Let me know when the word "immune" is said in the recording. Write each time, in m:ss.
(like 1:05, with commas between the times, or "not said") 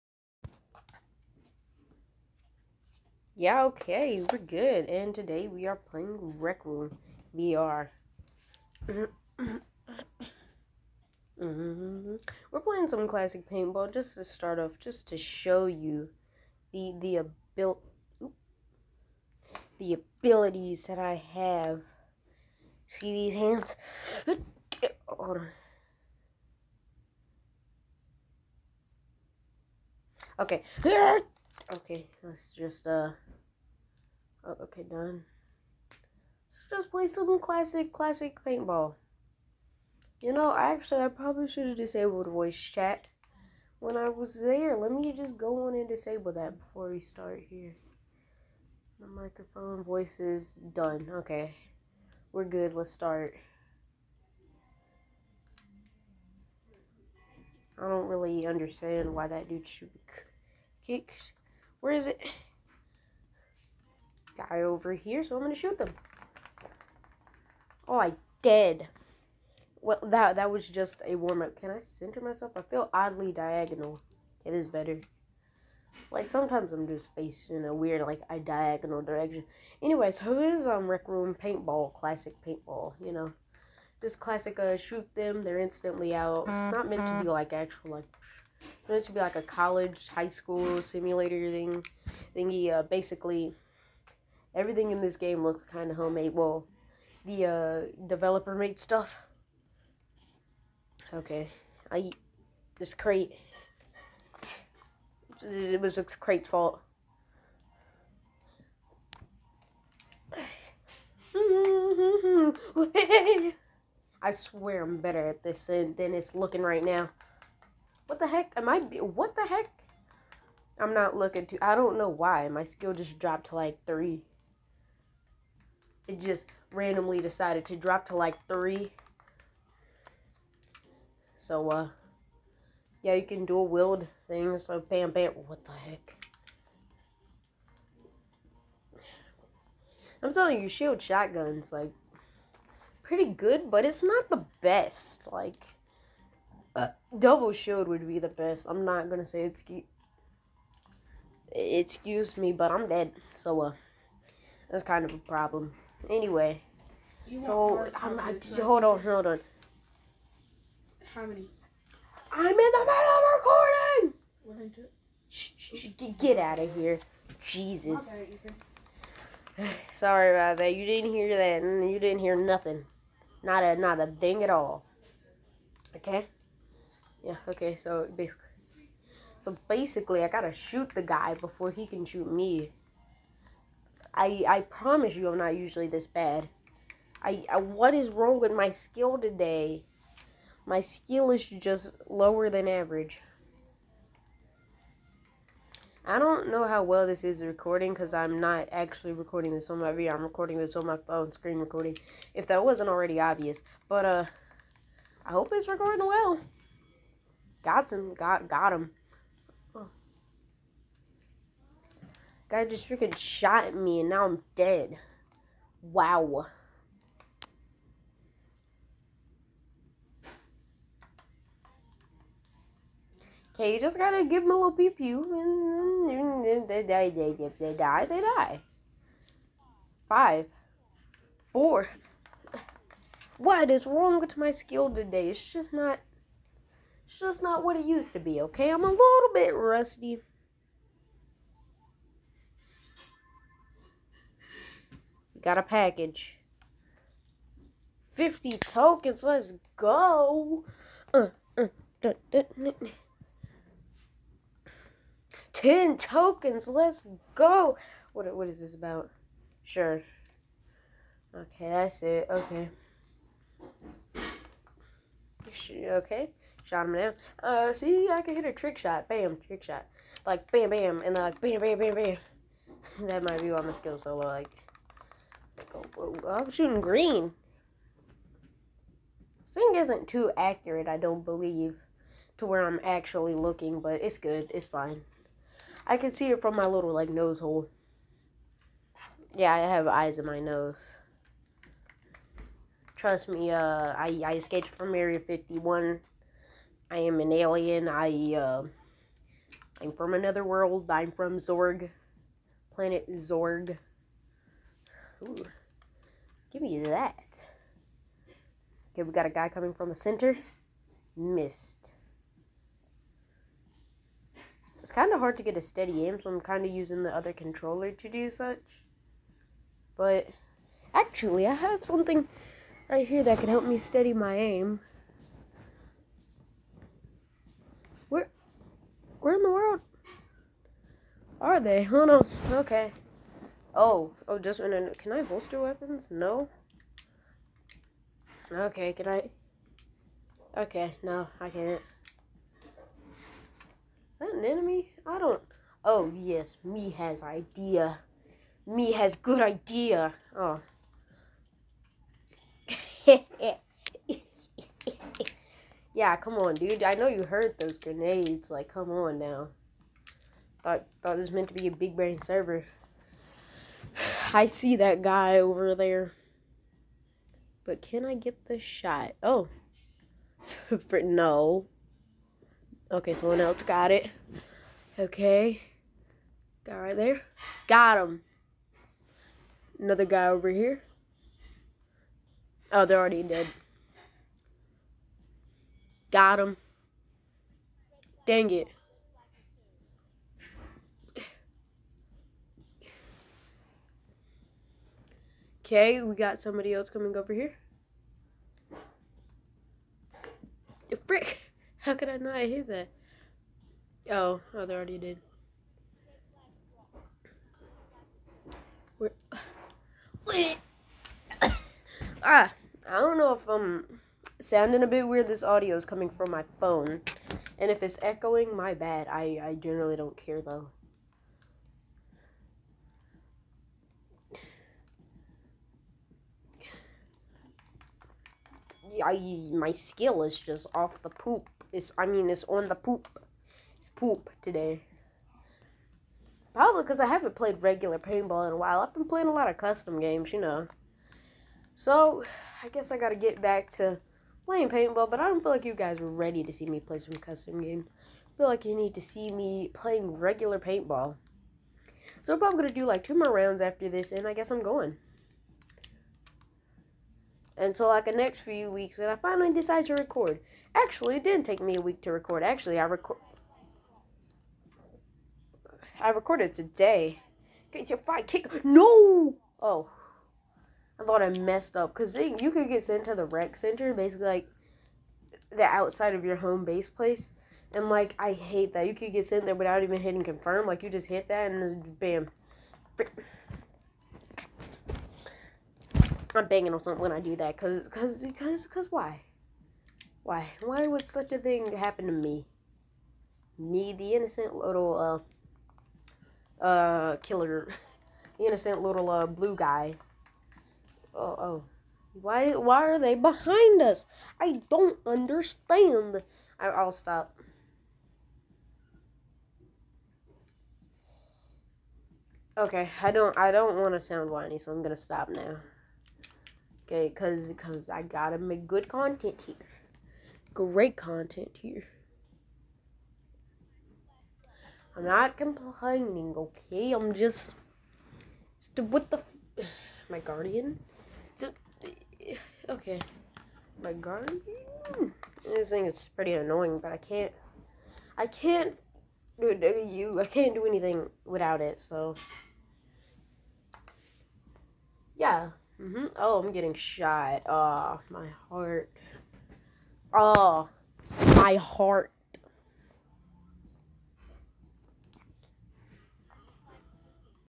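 not said.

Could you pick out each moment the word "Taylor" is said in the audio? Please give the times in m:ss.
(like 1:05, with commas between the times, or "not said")
not said.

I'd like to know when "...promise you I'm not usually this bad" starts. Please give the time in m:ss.
3:04.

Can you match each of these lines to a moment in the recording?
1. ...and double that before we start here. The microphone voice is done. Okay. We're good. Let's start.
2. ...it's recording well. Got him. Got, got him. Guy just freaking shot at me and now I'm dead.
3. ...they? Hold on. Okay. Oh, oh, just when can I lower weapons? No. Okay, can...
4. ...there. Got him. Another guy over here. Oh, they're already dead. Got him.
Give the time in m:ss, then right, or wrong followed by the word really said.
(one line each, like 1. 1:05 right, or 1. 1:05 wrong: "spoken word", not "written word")
1. 0:45 wrong: "disable", not "double"
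2. 3:25 right
3. 5:31 wrong: "holster", not "lower"
4. 6:16 right.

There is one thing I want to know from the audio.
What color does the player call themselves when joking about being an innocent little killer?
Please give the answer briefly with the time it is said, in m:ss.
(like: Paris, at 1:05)
blue, at 8:19.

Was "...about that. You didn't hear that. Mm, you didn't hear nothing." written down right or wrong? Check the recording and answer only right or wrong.
right.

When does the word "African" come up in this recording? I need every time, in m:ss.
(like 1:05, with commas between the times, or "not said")
not said.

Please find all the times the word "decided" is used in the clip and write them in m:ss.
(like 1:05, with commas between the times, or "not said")
2:07, 7:39.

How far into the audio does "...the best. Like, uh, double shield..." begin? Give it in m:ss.
2:24.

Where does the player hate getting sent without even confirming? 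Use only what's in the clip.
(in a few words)
rec center.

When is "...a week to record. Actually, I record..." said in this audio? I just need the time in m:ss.
7:41.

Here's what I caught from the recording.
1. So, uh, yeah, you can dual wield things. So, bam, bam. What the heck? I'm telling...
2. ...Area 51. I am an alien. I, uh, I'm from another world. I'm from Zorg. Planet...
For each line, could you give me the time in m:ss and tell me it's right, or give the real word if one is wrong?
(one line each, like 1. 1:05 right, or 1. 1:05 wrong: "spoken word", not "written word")
1. 2:11 right
2. 4:54 right.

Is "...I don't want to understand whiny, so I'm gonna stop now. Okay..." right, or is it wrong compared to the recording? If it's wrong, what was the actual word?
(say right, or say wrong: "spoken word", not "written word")
wrong: "sound", not "understand".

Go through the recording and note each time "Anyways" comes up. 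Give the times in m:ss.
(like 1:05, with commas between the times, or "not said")
1:19, 2:36.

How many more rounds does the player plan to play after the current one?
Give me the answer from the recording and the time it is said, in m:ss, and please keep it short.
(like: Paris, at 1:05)
2, at 7:33.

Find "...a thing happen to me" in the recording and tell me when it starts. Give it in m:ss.
8:11.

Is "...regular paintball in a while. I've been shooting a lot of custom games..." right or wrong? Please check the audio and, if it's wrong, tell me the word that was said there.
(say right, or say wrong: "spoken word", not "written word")
wrong: "playing", not "shooting".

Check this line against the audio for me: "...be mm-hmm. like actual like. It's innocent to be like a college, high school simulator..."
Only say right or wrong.
wrong.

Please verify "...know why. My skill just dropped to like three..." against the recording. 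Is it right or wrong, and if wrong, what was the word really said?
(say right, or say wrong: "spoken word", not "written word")
right.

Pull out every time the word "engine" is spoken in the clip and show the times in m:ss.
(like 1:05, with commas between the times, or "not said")
not said.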